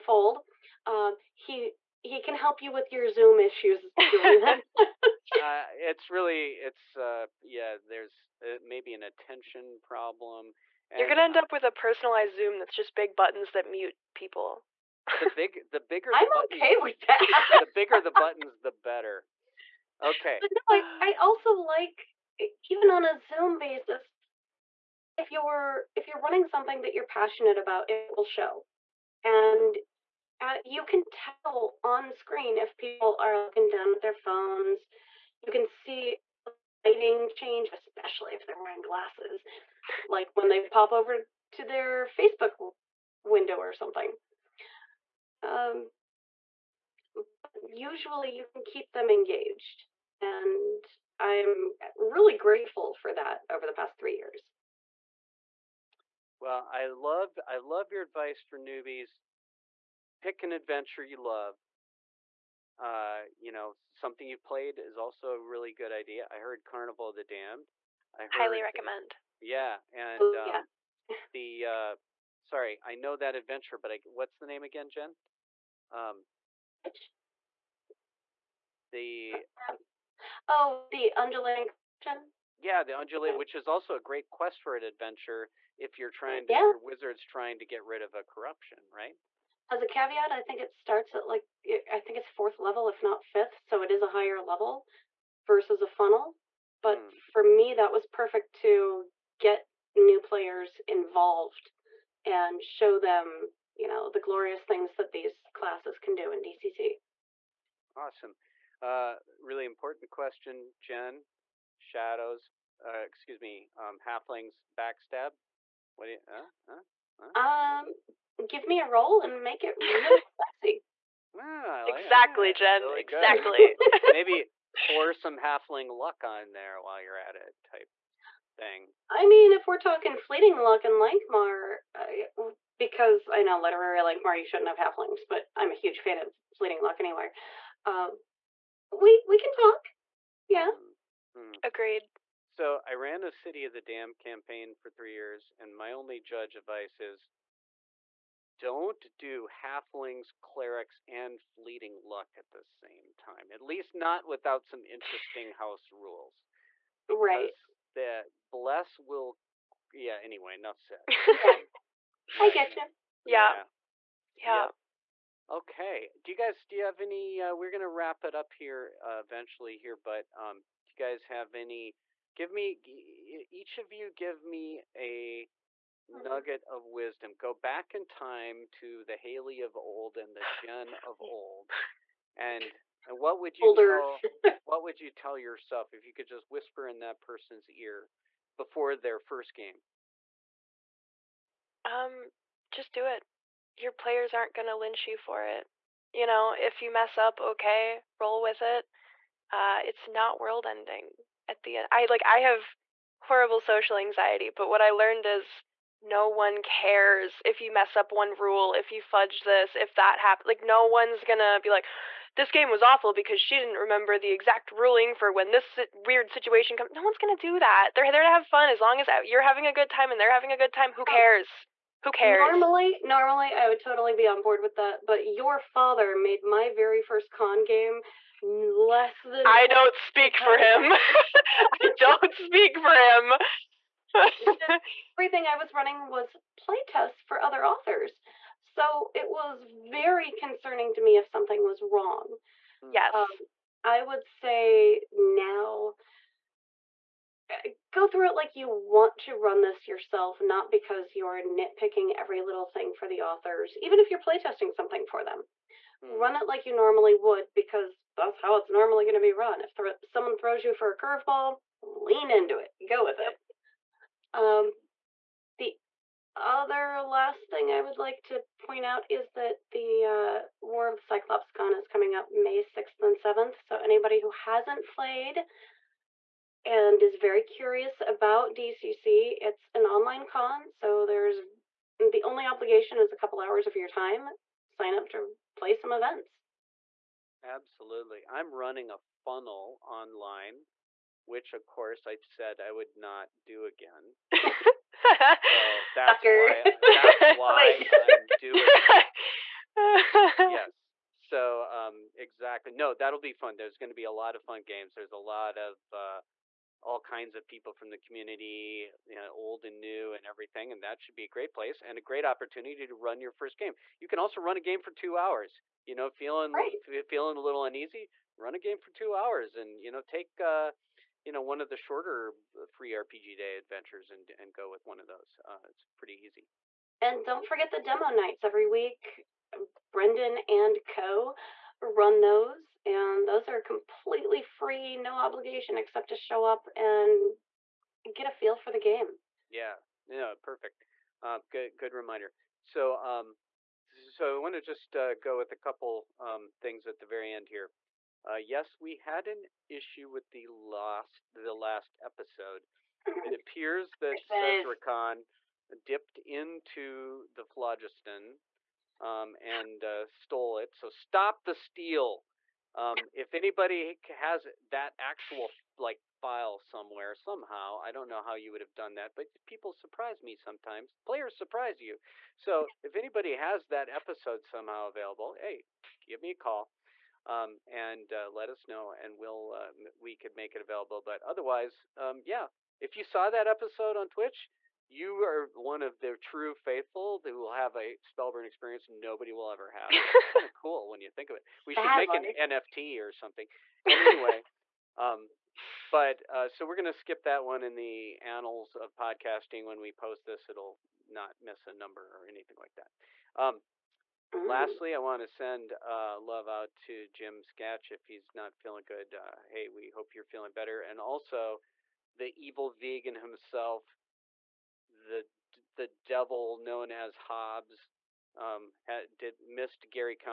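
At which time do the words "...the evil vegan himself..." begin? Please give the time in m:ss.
6:52.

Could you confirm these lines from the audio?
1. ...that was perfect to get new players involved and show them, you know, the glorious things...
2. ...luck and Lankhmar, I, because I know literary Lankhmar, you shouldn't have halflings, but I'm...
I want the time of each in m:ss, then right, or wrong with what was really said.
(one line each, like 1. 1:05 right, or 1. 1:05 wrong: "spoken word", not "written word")
1. 1:37 right
2. 2:10 right.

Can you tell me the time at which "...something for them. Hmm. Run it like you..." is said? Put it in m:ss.
4:14.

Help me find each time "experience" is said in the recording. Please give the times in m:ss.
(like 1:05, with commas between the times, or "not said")
6:28.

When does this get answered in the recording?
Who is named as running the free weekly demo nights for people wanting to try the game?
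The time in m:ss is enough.
5:29.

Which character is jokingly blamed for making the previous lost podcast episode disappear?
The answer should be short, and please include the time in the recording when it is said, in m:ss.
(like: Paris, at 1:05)
Sezrekan, at 5:54.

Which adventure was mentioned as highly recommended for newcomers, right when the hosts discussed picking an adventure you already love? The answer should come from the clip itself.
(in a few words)
Carnival of the Damned.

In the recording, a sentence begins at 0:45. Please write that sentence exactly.
Um, usually you can keep them engaged.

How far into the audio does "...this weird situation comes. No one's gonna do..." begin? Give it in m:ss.
3:35.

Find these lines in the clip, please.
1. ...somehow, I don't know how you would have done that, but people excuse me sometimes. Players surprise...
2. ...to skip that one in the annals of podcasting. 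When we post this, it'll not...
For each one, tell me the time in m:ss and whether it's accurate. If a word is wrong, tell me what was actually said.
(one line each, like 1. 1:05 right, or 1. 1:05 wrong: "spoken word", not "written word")
1. 6:07 wrong: "surprise", not "excuse"
2. 6:36 right.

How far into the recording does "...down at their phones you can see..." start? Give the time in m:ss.
0:33.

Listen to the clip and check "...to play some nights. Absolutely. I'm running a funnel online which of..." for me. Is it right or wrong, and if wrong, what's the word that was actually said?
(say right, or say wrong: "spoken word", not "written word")
wrong: "events", not "nights".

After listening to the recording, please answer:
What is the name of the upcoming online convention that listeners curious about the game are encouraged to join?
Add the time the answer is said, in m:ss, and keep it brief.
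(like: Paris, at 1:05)
War of the Cyclops Con, at 4:30.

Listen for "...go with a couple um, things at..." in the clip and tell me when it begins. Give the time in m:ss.
5:45.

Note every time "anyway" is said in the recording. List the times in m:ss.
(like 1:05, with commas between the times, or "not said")
2:16, 2:40, 6:34.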